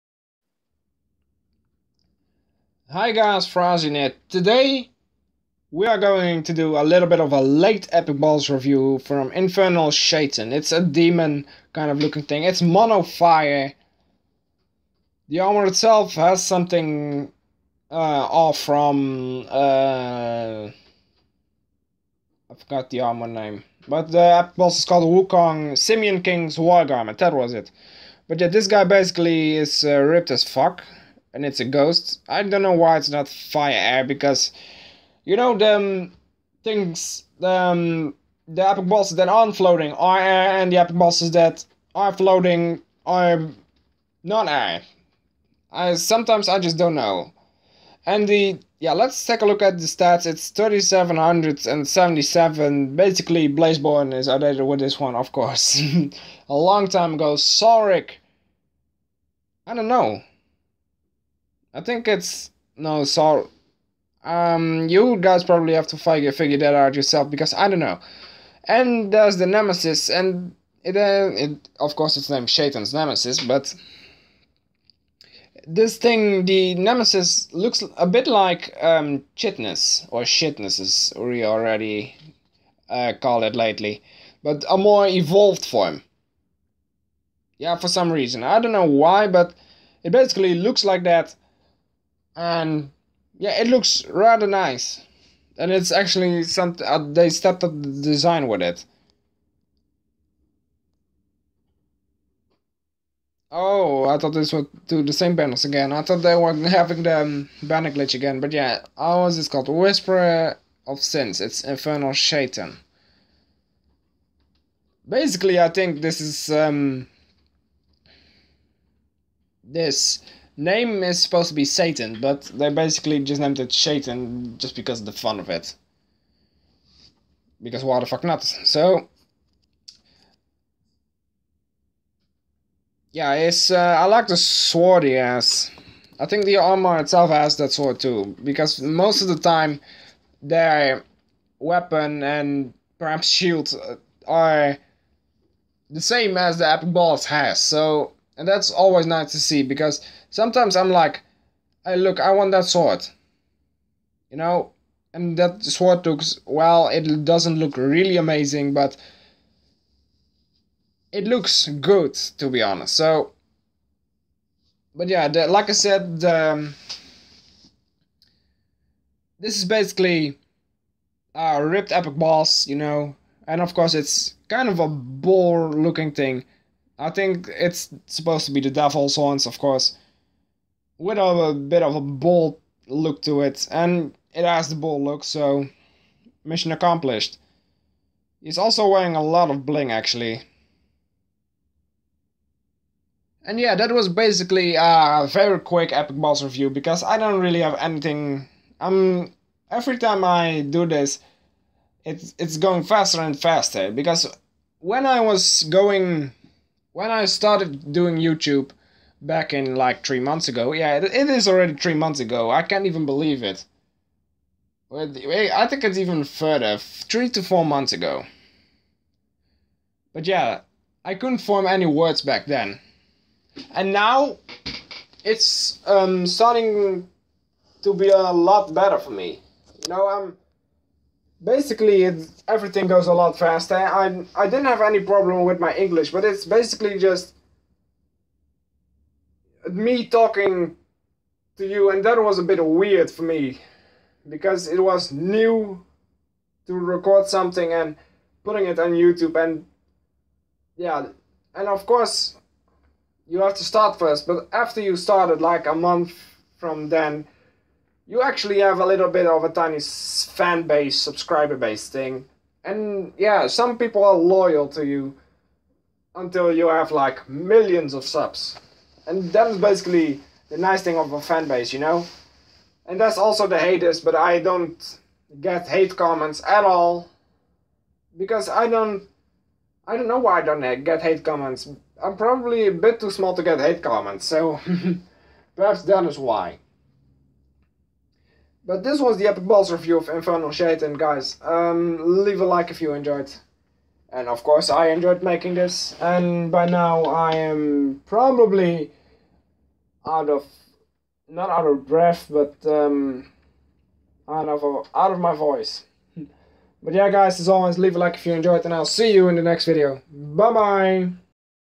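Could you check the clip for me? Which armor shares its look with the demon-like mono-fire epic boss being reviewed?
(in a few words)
Wukong Simian King's War Garment.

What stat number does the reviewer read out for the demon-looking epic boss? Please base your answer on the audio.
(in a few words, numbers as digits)
3777.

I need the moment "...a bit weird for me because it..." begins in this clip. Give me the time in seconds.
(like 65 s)
242 s.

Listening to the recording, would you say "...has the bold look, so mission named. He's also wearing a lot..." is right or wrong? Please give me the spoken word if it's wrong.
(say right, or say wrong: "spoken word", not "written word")
wrong: "accomplished", not "named".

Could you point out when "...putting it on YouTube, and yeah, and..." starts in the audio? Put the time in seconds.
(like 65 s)
248 s.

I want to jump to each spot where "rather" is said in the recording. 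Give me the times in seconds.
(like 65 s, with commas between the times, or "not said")
94 s.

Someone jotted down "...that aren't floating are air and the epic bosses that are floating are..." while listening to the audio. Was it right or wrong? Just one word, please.
right.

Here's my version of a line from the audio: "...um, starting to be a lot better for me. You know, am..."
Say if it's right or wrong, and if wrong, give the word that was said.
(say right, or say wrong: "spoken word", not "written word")
right.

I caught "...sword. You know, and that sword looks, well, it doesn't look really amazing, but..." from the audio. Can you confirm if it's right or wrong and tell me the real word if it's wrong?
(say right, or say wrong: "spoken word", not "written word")
right.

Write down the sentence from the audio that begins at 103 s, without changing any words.
Oh, I thought this would do the same banners again.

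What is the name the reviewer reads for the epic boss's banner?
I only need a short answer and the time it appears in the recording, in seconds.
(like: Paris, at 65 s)
Whisperer of Sins, at 109 s.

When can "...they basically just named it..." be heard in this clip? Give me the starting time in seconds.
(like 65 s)
122 s.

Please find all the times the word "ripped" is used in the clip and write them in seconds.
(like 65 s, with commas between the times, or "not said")
30 s, 171 s.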